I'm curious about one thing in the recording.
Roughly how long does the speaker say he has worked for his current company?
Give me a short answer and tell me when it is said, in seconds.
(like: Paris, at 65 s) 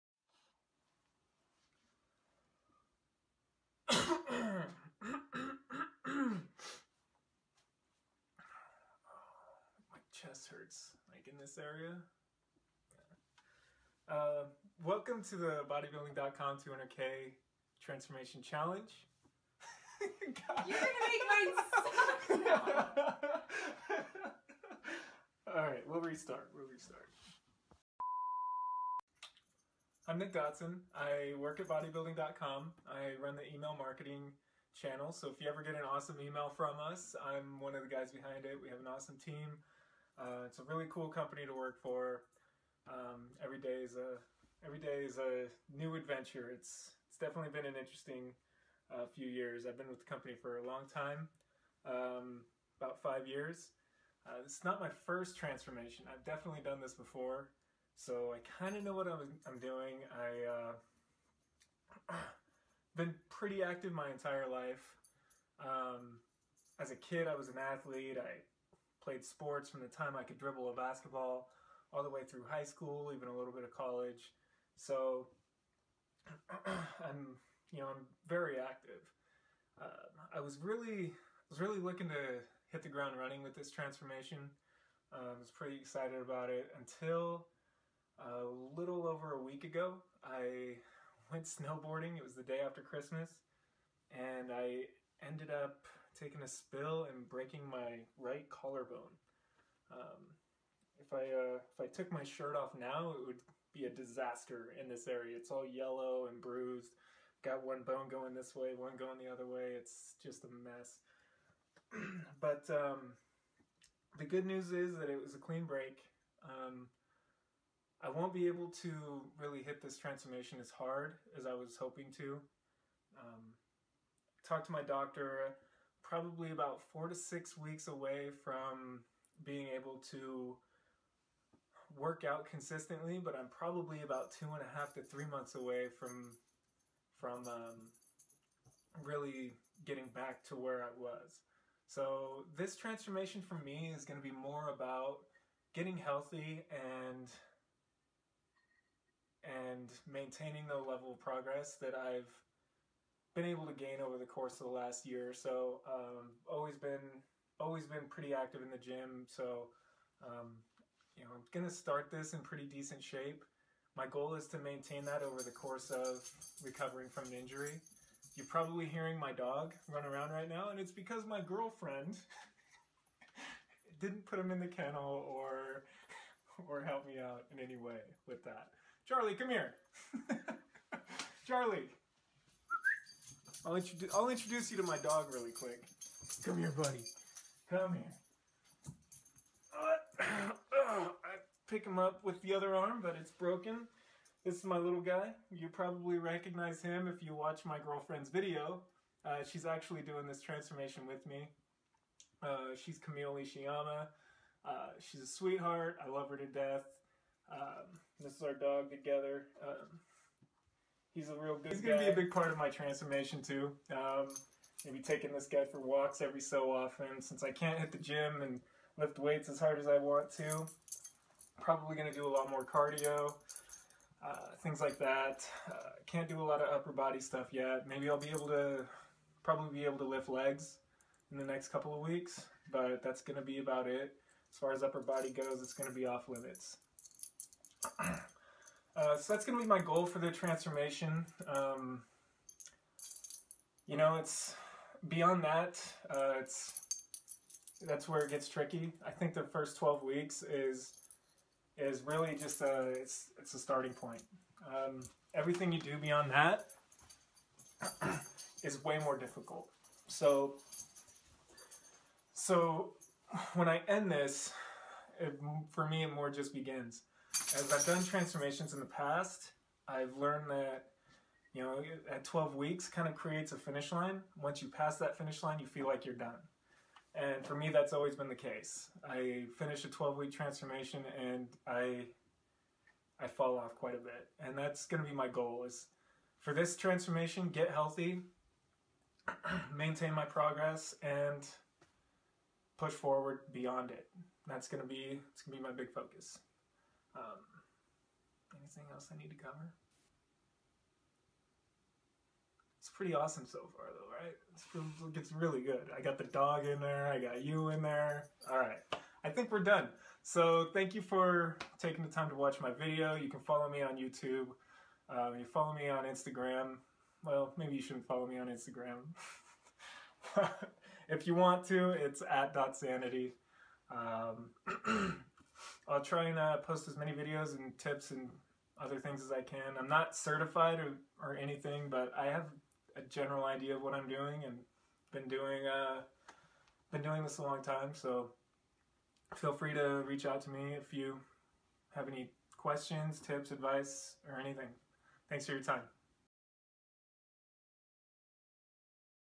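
About 5 years, at 52 s.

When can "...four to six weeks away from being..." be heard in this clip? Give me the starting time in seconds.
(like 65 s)
126 s.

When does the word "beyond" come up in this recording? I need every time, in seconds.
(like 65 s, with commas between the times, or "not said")
245 s, 255 s, 293 s.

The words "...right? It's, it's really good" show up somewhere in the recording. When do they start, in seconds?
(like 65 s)
304 s.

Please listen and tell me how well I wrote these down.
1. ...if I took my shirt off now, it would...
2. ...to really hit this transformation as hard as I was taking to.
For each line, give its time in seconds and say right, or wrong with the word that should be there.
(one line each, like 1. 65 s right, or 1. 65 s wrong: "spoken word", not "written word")
1. 101 s right
2. 118 s wrong: "hoping", not "taking".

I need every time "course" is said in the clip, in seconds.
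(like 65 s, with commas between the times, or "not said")
154 s, 165 s.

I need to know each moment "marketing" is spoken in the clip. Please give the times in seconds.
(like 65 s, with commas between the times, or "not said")
33 s.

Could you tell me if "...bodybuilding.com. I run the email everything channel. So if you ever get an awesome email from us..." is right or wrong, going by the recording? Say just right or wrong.
wrong.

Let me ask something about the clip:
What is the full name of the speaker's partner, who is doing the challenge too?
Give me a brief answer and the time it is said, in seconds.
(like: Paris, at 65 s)
Camille Ishiyama, at 202 s.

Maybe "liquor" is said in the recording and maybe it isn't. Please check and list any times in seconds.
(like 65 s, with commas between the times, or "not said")
not said.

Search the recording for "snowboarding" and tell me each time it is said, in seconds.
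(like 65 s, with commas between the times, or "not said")
91 s.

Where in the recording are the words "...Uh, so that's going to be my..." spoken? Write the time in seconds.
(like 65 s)
238 s.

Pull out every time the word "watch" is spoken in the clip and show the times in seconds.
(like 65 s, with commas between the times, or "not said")
197 s, 312 s.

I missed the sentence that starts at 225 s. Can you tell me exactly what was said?
Uh, can't do a lot of upper body stuff yet.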